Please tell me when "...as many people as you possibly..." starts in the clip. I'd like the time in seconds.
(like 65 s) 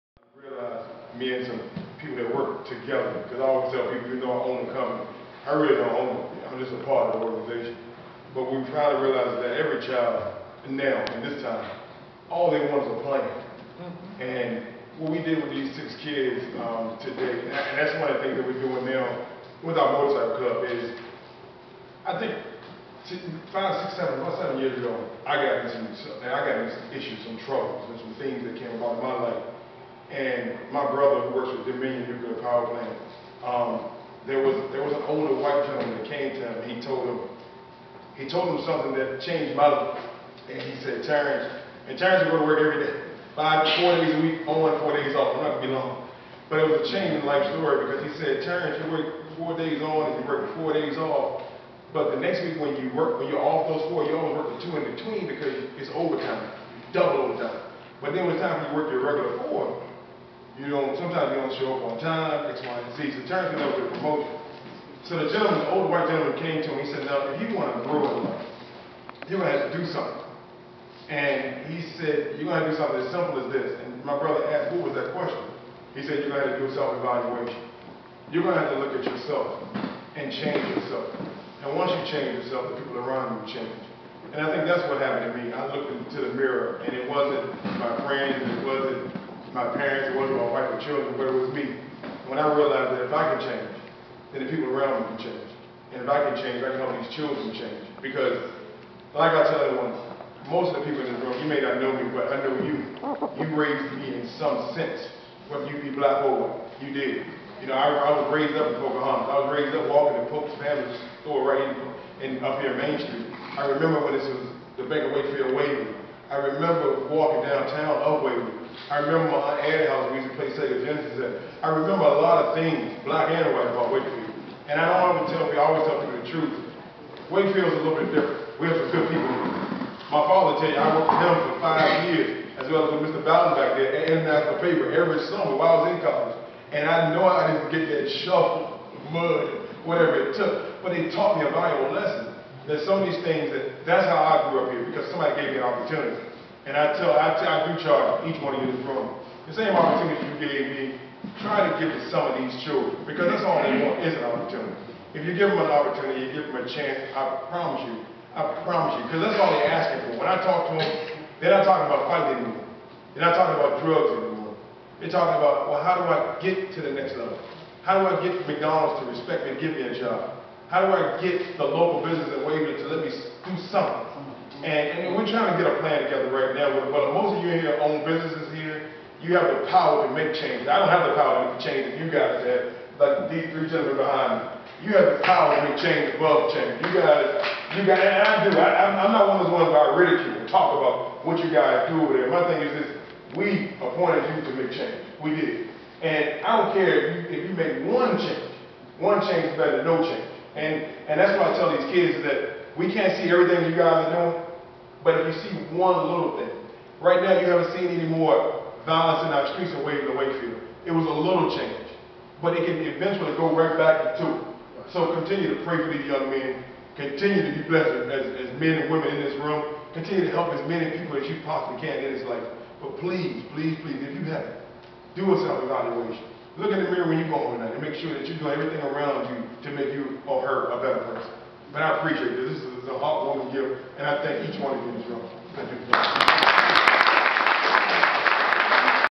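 220 s.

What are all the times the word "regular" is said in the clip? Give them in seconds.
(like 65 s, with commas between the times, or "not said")
59 s.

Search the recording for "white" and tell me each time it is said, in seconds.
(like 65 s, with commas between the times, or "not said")
35 s, 65 s, 106 s, 123 s.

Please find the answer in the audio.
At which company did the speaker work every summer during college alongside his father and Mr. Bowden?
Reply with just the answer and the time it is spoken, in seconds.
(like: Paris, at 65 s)
International Paper, at 134 s.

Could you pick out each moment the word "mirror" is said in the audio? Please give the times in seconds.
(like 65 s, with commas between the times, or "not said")
86 s, 226 s.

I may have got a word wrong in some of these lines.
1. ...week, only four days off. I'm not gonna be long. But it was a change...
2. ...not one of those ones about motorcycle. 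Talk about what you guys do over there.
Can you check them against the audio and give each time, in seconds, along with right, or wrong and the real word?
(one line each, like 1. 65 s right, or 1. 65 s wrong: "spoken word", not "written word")
1. 44 s right
2. 189 s wrong: "ridicule", not "motorcycle".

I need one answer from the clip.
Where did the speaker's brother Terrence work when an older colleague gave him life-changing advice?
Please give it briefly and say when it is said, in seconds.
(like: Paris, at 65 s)
Dominion Nuclear Power Plant, at 31 s.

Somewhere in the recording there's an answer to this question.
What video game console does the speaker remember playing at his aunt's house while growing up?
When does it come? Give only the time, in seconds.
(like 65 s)
120 s.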